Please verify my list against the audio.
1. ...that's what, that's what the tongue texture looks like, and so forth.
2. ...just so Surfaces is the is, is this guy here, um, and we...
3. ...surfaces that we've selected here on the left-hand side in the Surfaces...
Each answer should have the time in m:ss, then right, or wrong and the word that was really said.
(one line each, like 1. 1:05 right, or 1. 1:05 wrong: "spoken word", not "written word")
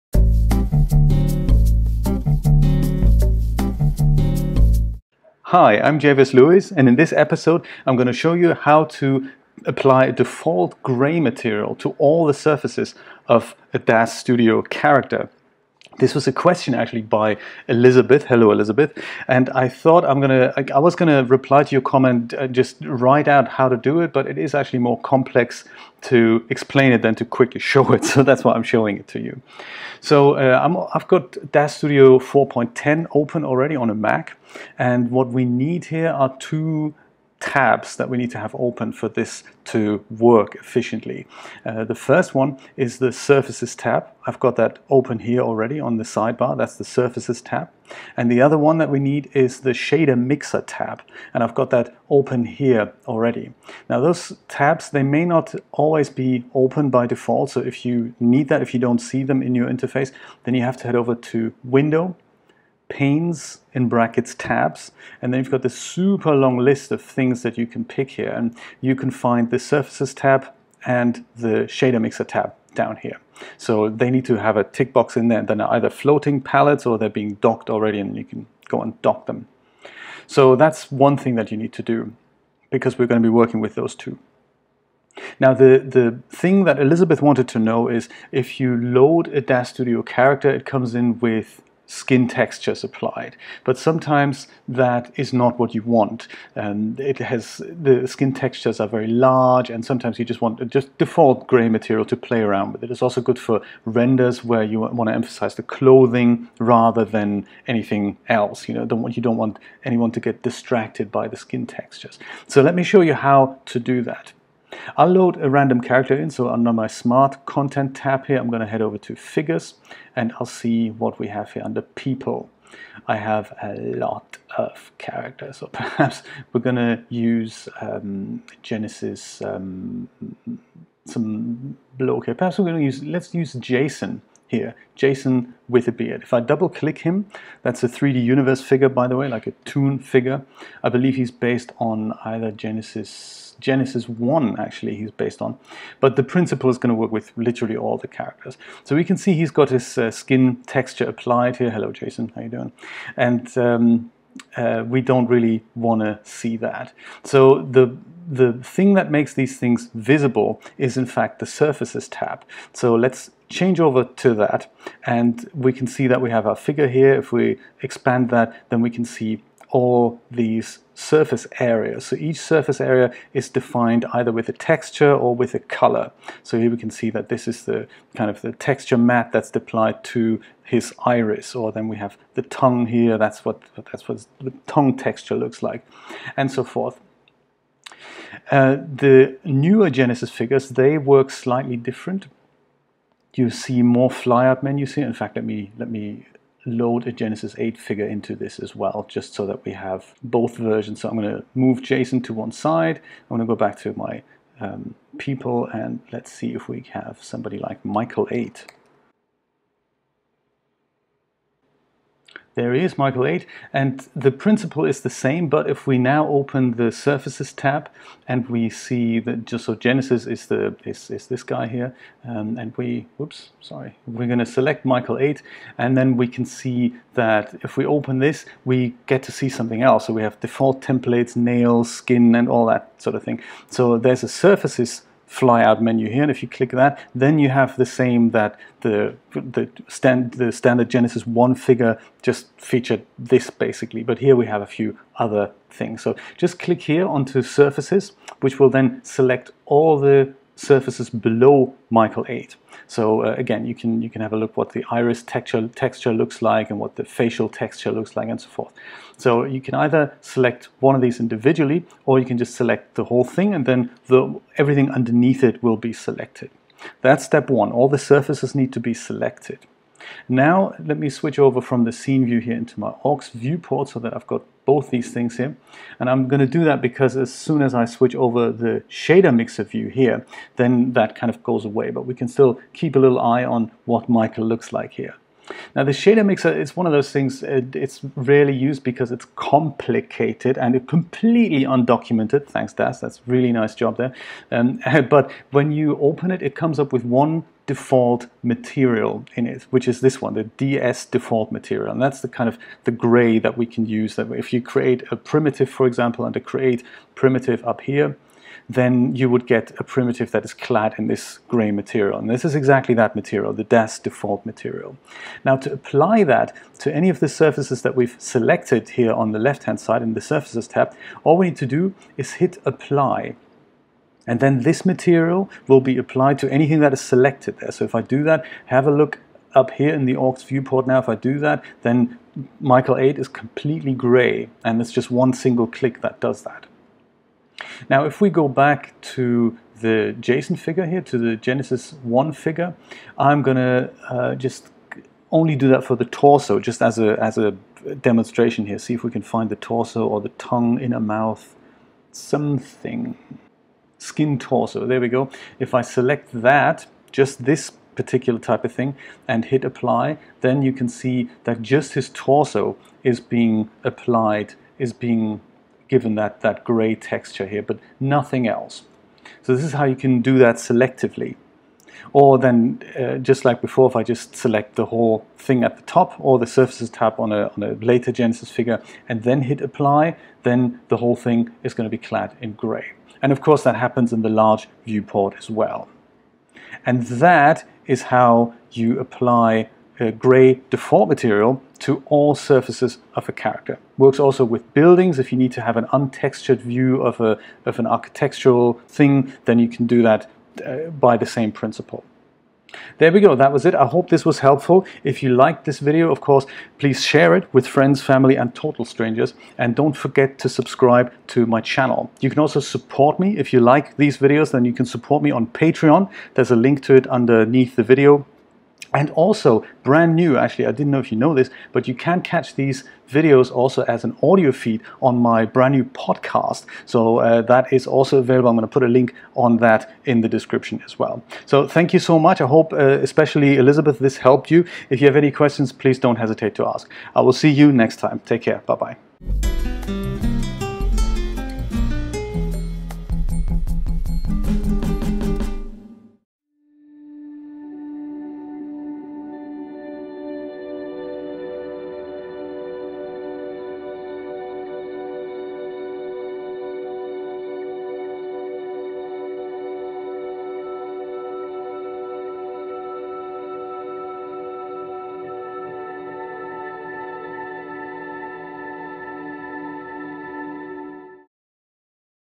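1. 3:03 right
2. 3:39 wrong: "Genesis", not "Surfaces"
3. 5:17 right.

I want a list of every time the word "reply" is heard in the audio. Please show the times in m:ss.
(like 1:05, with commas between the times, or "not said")
0:21.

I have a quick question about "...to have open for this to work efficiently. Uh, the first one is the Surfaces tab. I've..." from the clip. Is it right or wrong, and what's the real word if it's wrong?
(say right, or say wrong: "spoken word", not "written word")
right.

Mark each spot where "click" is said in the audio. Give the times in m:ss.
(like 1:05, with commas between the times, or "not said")
2:16, 3:56, 4:06, 5:35.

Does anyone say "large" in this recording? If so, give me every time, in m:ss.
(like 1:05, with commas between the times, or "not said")
1:39, 6:24.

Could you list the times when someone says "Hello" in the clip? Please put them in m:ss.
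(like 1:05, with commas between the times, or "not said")
0:18, 2:31.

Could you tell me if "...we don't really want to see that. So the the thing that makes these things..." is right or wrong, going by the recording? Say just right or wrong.
right.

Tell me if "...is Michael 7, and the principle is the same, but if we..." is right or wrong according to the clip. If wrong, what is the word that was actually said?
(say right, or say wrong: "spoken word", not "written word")
wrong: "8", not "7".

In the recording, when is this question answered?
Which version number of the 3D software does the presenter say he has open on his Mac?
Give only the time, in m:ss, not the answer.
0:31.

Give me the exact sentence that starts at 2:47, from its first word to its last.
If we expand that, then we can see all these surface areas.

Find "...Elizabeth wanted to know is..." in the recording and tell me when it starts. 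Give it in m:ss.
1:26.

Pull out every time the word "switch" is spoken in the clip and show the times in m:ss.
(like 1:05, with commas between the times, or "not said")
4:31, 4:37.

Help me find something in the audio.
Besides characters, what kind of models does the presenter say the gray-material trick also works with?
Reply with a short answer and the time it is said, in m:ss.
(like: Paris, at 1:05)
Buildings, at 6:33.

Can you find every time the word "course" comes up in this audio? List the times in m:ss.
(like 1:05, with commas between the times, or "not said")
6:23, 6:46.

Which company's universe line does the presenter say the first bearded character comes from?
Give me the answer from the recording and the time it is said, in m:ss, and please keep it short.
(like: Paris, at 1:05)
3D Universe, at 2:17.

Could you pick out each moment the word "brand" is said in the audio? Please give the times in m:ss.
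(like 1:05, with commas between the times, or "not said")
6:59, 7:05.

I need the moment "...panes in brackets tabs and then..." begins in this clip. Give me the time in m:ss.
1:02.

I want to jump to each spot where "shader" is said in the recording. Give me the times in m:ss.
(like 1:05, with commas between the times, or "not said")
0:49, 1:11, 4:38, 4:45.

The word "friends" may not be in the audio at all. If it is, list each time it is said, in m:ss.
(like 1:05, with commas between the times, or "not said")
6:47.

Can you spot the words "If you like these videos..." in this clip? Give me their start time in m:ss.
6:53.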